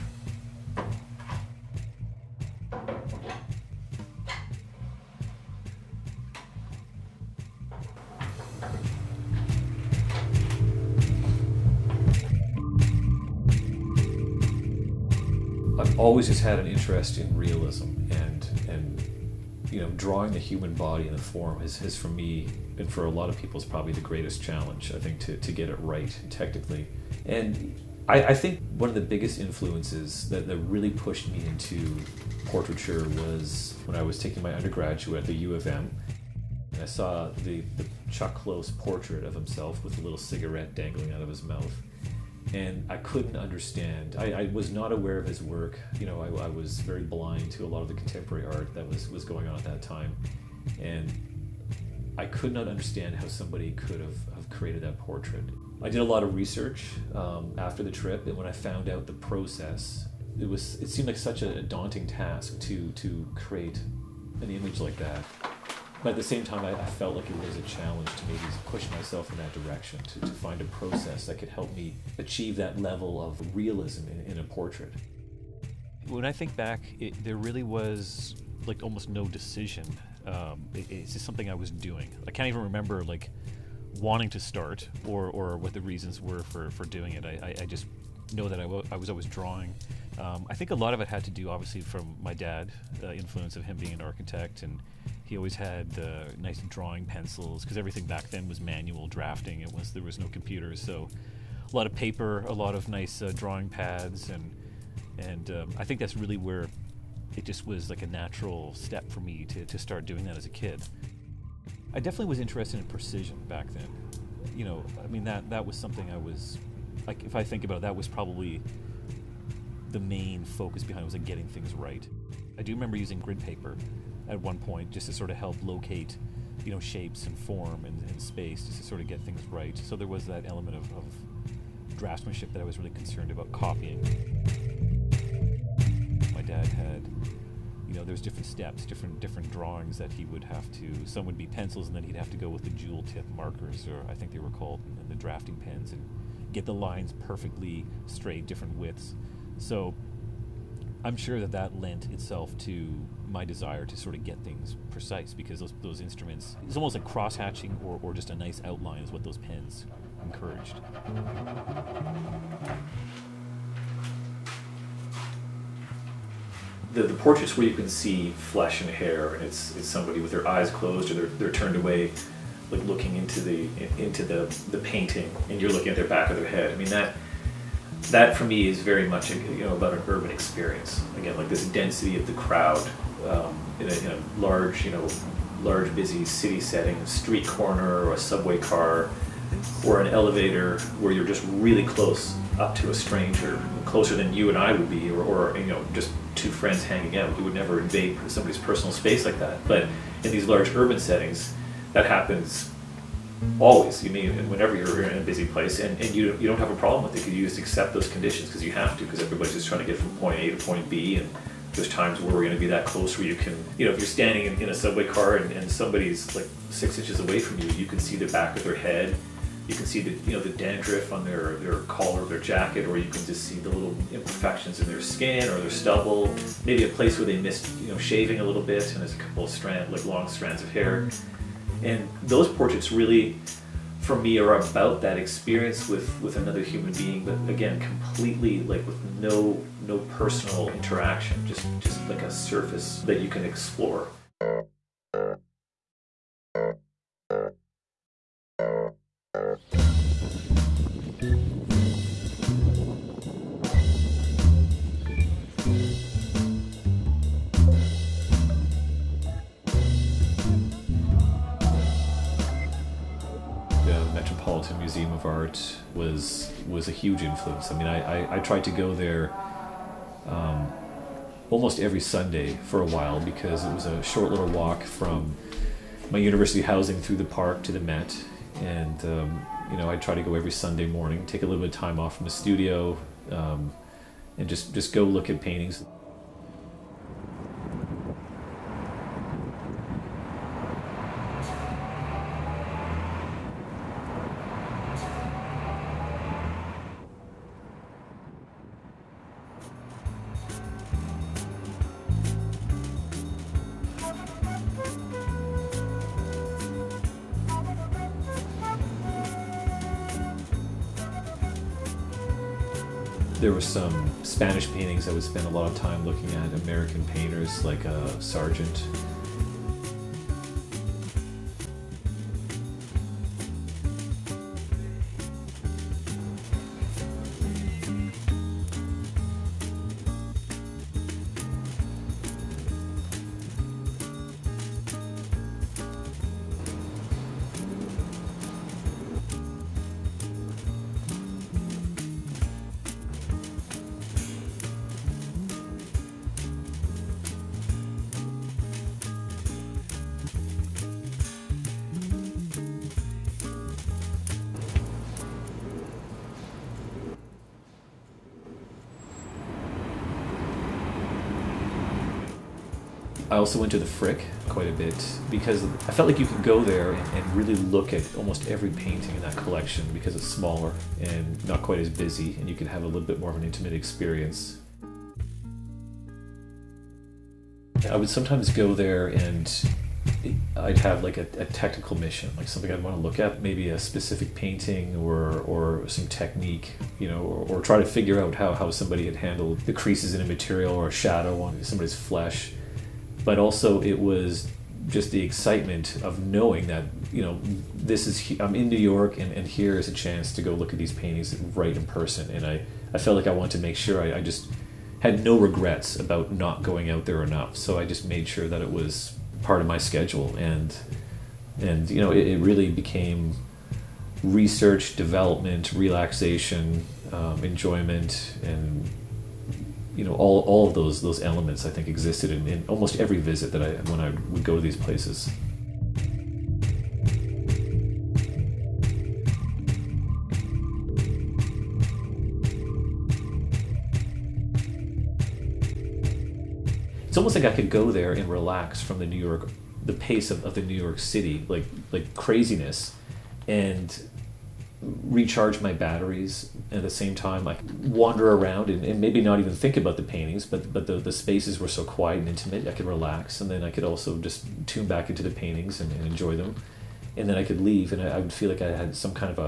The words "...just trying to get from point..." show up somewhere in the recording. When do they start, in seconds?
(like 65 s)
209 s.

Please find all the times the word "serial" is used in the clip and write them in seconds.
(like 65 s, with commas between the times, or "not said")
not said.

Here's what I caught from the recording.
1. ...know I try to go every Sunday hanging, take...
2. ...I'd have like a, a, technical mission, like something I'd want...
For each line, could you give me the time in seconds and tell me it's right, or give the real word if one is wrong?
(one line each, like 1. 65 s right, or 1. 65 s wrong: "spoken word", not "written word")
1. 279 s wrong: "morning", not "hanging"
2. 380 s right.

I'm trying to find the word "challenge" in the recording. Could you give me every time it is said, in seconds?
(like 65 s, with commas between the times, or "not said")
24 s, 67 s.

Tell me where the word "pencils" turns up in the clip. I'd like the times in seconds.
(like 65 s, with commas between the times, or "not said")
97 s, 141 s.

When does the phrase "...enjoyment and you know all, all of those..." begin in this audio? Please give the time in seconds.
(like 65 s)
417 s.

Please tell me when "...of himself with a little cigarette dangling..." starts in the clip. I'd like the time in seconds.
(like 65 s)
39 s.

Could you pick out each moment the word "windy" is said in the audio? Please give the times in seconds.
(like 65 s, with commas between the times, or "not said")
not said.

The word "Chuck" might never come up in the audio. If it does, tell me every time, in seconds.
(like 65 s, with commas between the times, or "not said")
38 s.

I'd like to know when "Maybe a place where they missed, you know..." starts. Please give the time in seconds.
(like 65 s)
226 s.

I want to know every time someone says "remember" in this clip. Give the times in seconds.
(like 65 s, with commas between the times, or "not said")
82 s, 122 s.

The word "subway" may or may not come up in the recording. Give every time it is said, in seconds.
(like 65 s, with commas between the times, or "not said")
188 s, 214 s.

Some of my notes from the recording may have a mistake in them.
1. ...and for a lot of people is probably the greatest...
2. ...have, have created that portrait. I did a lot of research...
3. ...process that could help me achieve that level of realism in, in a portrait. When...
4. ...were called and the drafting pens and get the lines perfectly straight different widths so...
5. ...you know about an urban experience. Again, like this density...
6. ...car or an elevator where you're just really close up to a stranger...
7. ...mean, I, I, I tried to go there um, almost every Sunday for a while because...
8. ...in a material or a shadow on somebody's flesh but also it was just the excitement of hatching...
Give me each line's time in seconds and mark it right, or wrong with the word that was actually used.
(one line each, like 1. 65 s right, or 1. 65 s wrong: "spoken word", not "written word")
1. 22 s right
2. 53 s right
3. 70 s right
4. 144 s right
5. 179 s right
6. 188 s right
7. 267 s right
8. 390 s wrong: "knowing", not "hatching".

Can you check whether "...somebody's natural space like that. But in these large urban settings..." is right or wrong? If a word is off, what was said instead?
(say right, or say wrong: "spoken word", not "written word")
wrong: "personal", not "natural".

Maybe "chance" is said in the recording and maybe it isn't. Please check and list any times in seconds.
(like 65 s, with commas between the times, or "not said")
399 s.